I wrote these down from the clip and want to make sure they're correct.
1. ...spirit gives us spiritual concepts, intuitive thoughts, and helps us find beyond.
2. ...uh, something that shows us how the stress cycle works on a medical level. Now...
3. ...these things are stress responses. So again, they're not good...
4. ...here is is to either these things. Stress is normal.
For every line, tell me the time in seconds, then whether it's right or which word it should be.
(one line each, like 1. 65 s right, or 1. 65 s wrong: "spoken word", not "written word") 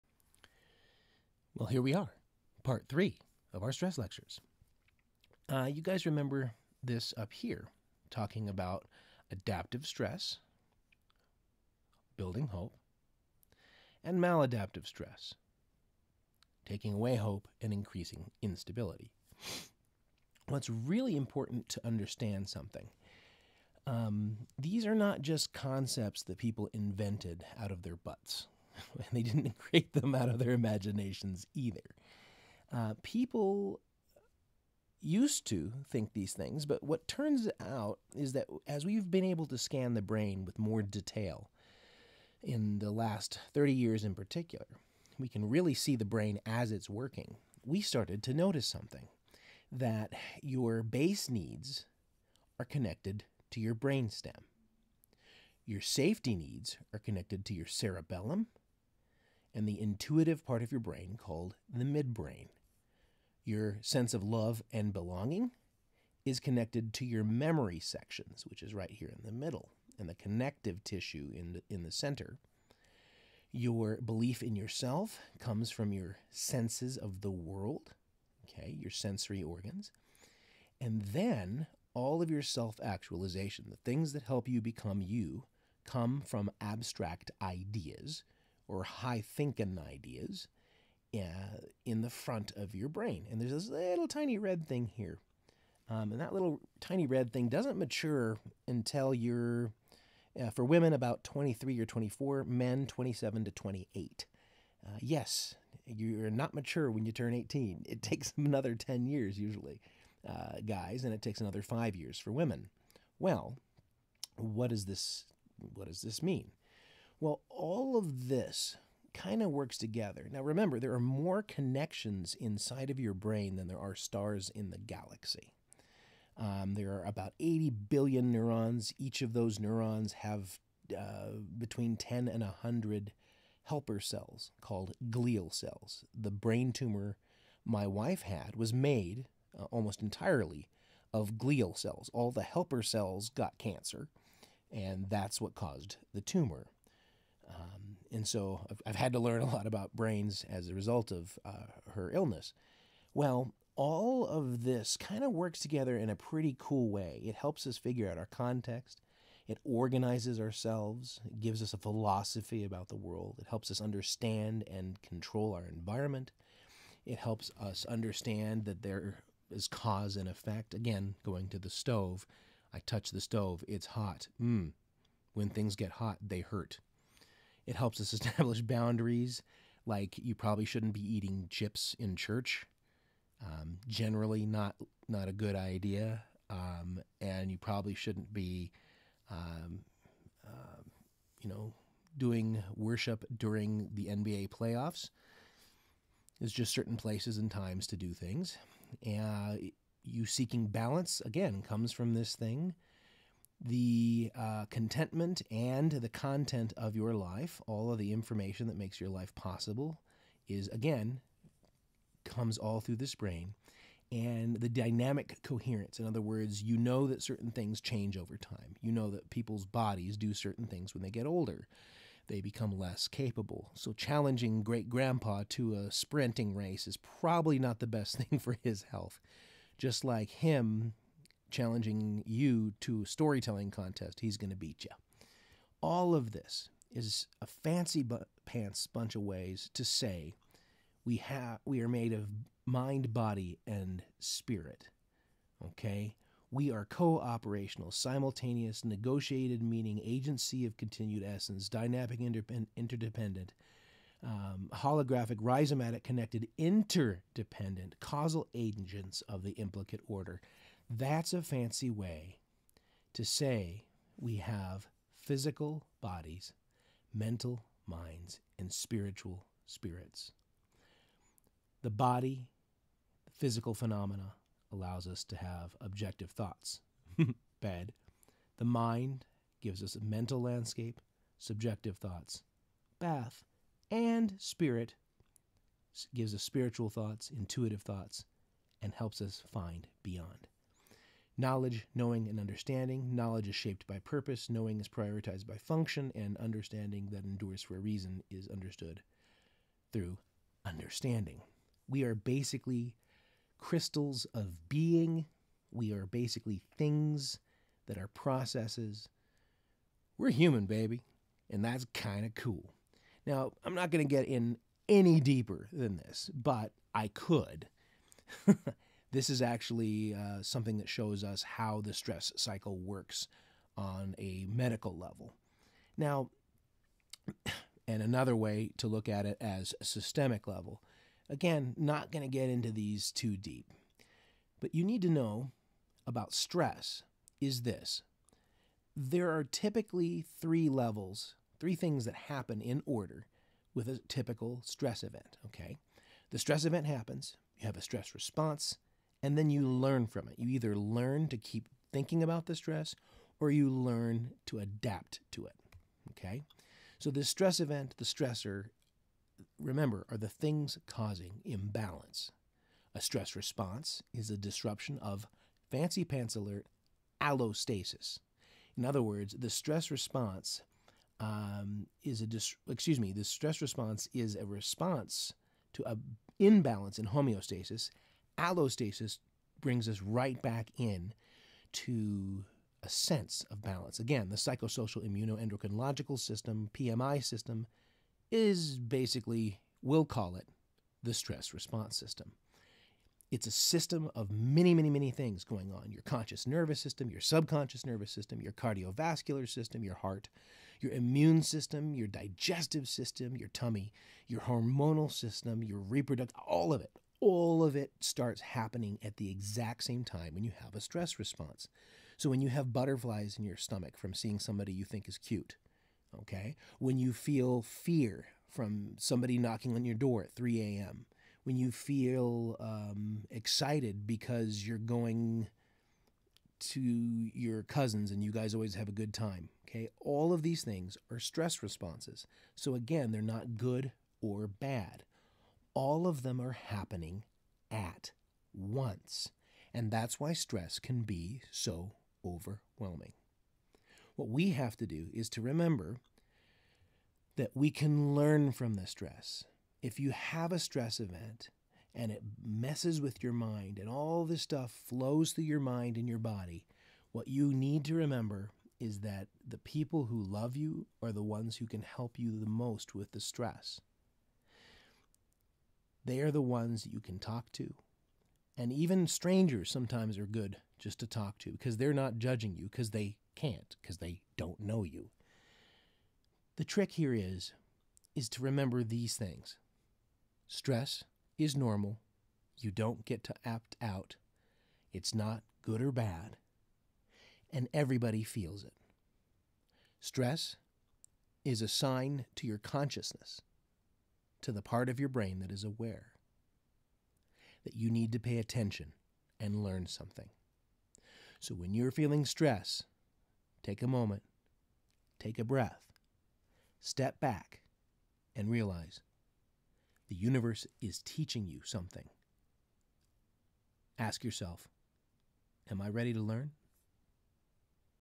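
1. 284 s wrong: "thoughts", not "concepts"
2. 320 s right
3. 430 s right
4. 476 s wrong: "remember", not "either".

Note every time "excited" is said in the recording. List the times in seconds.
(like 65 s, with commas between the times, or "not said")
423 s.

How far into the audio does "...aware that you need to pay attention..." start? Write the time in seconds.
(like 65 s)
495 s.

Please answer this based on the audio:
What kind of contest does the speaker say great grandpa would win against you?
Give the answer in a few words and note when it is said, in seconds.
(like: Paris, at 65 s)
storytelling contest, at 233 s.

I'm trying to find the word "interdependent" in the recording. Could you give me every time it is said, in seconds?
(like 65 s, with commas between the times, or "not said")
252 s, 256 s.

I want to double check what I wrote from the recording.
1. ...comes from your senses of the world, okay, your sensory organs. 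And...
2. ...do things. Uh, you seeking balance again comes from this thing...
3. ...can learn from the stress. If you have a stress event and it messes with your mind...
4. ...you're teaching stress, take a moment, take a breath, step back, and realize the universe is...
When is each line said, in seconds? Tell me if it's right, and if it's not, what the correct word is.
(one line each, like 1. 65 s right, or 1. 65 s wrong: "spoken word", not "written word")
1. 75 s right
2. 197 s right
3. 447 s right
4. 501 s wrong: "feeling", not "teaching".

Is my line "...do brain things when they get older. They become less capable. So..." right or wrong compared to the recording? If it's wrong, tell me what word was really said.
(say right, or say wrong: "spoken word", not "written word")
wrong: "certain", not "brain".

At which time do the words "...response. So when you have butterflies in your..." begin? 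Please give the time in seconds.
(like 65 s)
411 s.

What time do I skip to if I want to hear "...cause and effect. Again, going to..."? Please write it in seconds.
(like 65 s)
169 s.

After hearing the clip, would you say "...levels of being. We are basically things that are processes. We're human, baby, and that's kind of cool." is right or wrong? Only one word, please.
wrong.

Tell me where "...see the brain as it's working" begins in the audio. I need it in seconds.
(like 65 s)
45 s.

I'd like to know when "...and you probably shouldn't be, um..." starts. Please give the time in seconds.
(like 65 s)
187 s.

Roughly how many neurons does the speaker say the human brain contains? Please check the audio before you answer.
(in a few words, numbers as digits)
80 billion.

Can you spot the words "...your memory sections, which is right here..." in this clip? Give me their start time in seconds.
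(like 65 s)
67 s.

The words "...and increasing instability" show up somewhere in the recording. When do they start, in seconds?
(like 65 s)
17 s.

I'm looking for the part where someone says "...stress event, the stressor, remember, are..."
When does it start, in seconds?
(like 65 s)
357 s.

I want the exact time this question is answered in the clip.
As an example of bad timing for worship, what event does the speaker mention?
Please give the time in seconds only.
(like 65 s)
194 s.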